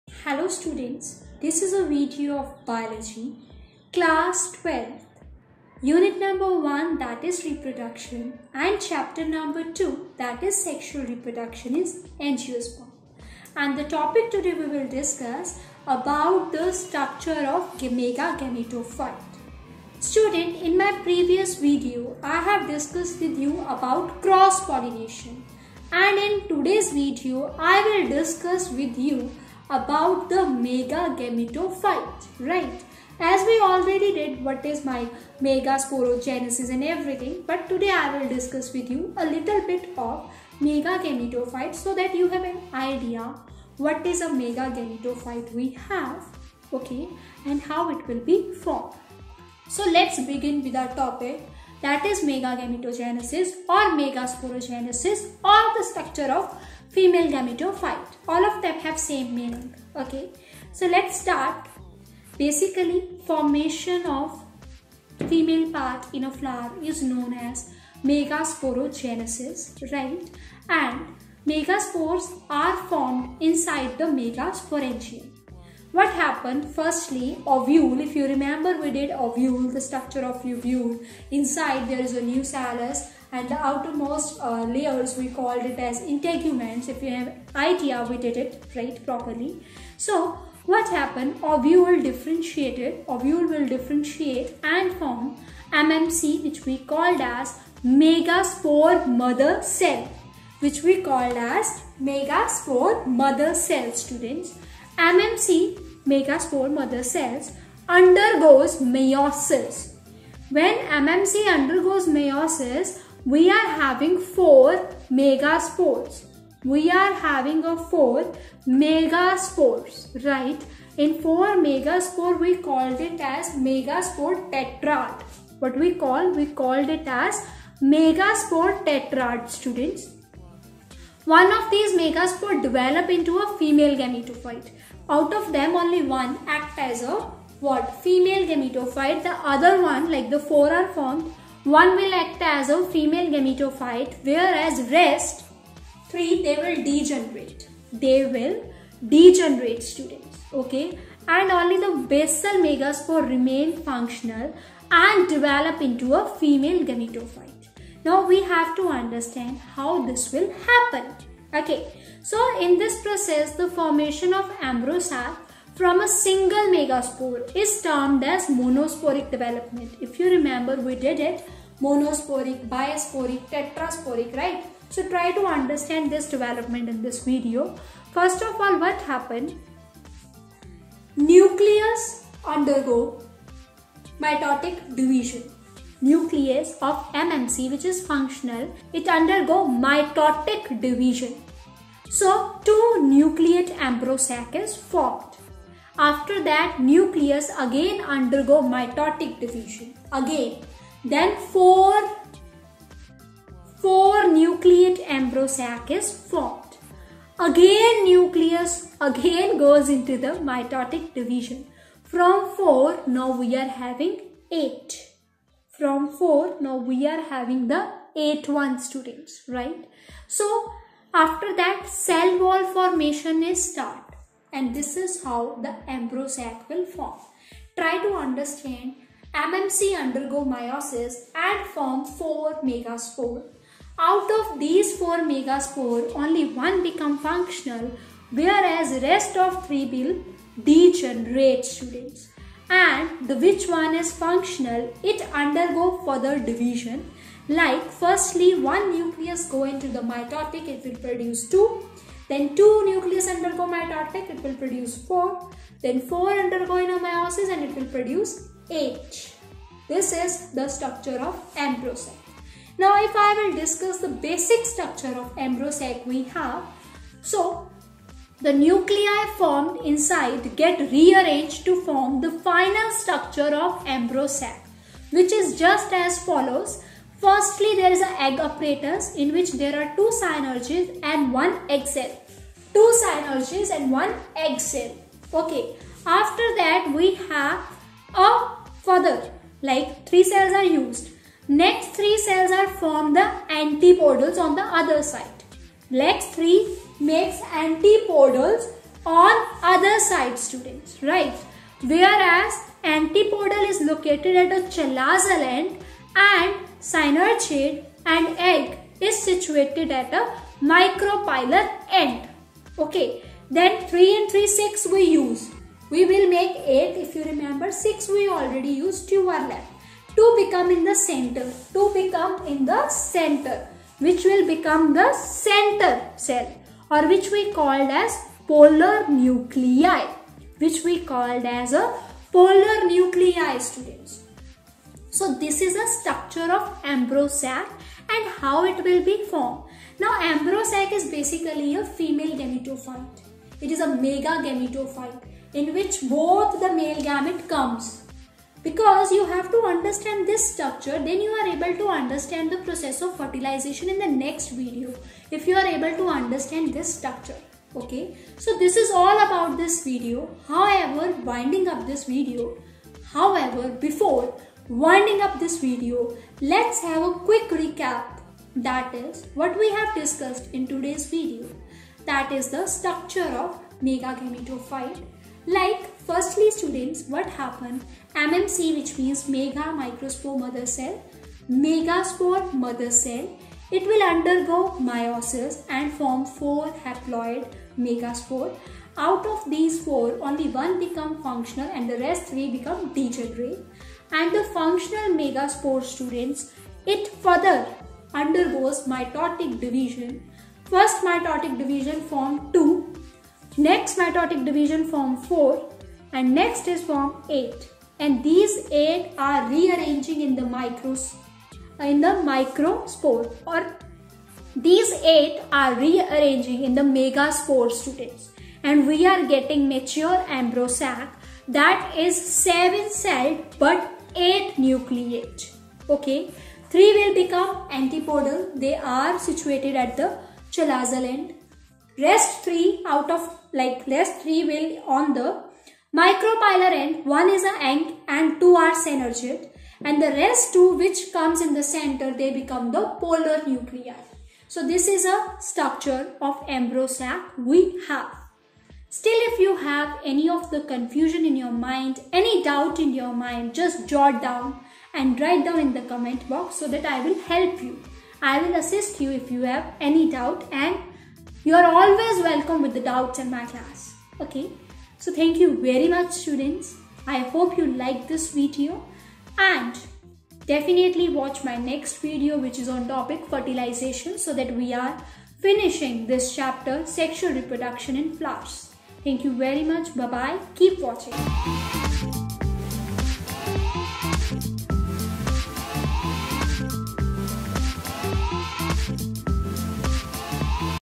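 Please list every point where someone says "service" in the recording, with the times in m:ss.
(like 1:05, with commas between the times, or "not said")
not said.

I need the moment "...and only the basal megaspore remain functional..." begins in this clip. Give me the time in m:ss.
2:31.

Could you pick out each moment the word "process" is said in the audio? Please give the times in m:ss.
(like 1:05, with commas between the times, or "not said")
2:43, 5:52.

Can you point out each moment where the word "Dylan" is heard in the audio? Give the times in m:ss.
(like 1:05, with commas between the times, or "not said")
not said.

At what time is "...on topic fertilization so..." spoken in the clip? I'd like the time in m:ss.
7:52.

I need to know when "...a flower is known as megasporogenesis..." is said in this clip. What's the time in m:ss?
1:06.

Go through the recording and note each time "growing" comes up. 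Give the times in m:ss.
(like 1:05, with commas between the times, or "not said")
not said.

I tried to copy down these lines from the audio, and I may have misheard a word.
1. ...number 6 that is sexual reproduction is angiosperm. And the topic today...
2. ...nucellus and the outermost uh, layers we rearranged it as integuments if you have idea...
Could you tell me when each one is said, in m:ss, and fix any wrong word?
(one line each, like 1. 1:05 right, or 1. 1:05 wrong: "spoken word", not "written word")
1. 0:09 wrong: "2", not "6"
2. 1:22 wrong: "called", not "rearranged".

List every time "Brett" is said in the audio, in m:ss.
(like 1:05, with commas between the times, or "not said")
not said.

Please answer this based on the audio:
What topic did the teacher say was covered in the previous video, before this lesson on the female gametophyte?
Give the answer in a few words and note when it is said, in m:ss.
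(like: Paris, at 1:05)
cross-pollination, at 0:24.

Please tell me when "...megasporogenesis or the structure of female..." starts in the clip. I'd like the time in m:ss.
0:54.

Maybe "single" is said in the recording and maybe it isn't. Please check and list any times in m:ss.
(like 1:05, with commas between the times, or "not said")
2:46.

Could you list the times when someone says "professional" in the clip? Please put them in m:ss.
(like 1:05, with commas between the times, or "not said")
not said.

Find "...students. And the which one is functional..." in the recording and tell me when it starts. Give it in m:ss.
4:01.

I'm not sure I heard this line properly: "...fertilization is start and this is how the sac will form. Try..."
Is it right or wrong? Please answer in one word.
wrong.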